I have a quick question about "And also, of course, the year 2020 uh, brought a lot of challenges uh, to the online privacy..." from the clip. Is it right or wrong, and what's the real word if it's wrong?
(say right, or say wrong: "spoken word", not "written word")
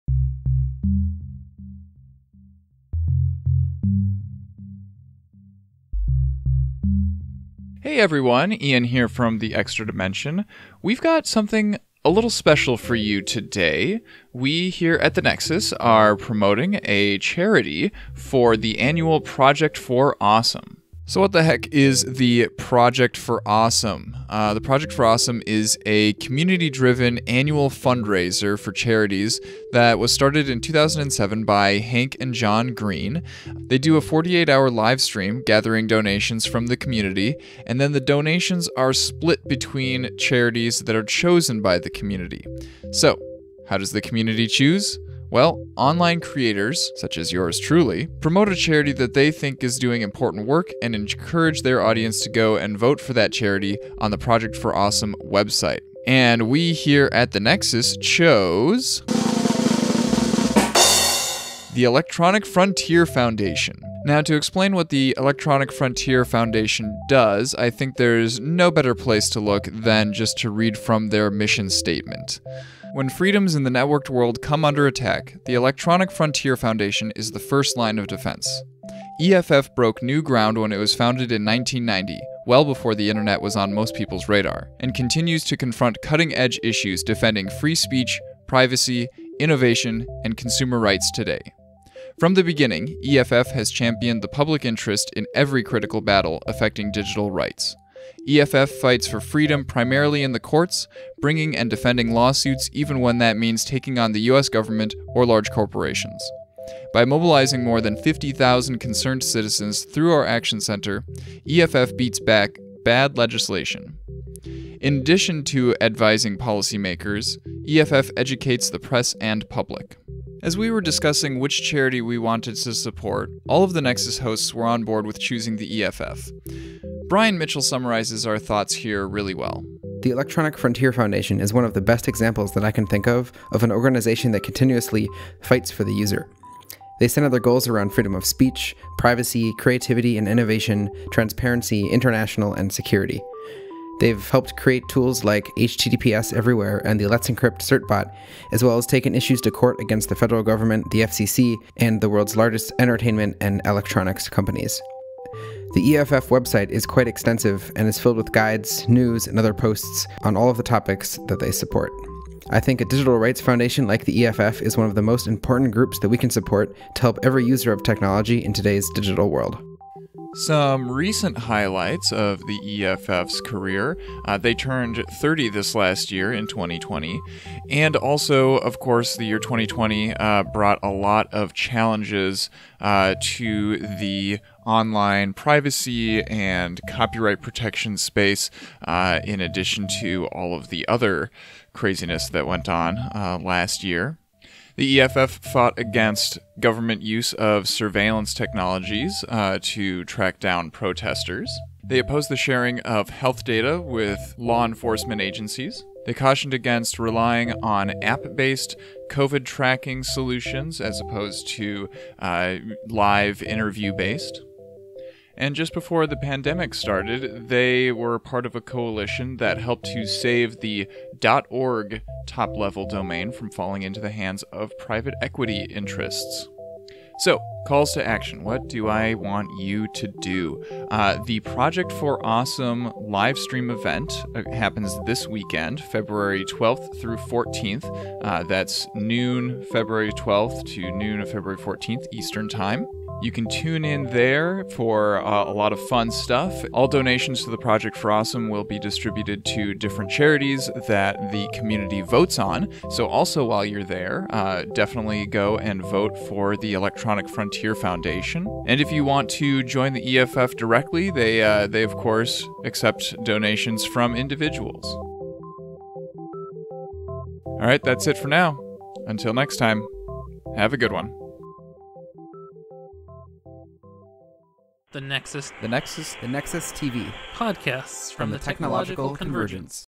right.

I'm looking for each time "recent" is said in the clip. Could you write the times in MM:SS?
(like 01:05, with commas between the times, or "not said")
02:50.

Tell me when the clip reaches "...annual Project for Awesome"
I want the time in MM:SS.
00:18.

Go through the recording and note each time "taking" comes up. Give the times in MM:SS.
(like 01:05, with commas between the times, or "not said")
01:43.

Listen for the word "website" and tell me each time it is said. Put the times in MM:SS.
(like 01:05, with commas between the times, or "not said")
00:55, 02:36.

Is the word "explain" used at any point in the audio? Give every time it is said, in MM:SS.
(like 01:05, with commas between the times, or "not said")
01:04.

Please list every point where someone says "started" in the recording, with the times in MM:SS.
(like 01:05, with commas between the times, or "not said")
00:30, 03:36.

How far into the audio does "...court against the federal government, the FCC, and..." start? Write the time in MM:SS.
02:29.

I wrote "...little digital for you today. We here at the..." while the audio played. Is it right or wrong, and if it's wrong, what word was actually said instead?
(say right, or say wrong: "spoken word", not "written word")
wrong: "special", not "digital".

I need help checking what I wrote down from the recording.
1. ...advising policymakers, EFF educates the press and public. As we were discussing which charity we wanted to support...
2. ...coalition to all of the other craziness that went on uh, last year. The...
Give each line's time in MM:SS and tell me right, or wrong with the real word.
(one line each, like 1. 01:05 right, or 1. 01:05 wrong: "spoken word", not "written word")
1. 01:55 right
2. 03:09 wrong: "addition", not "coalition".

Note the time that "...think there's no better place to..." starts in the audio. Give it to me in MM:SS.
01:07.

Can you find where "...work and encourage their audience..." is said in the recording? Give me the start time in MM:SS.
00:50.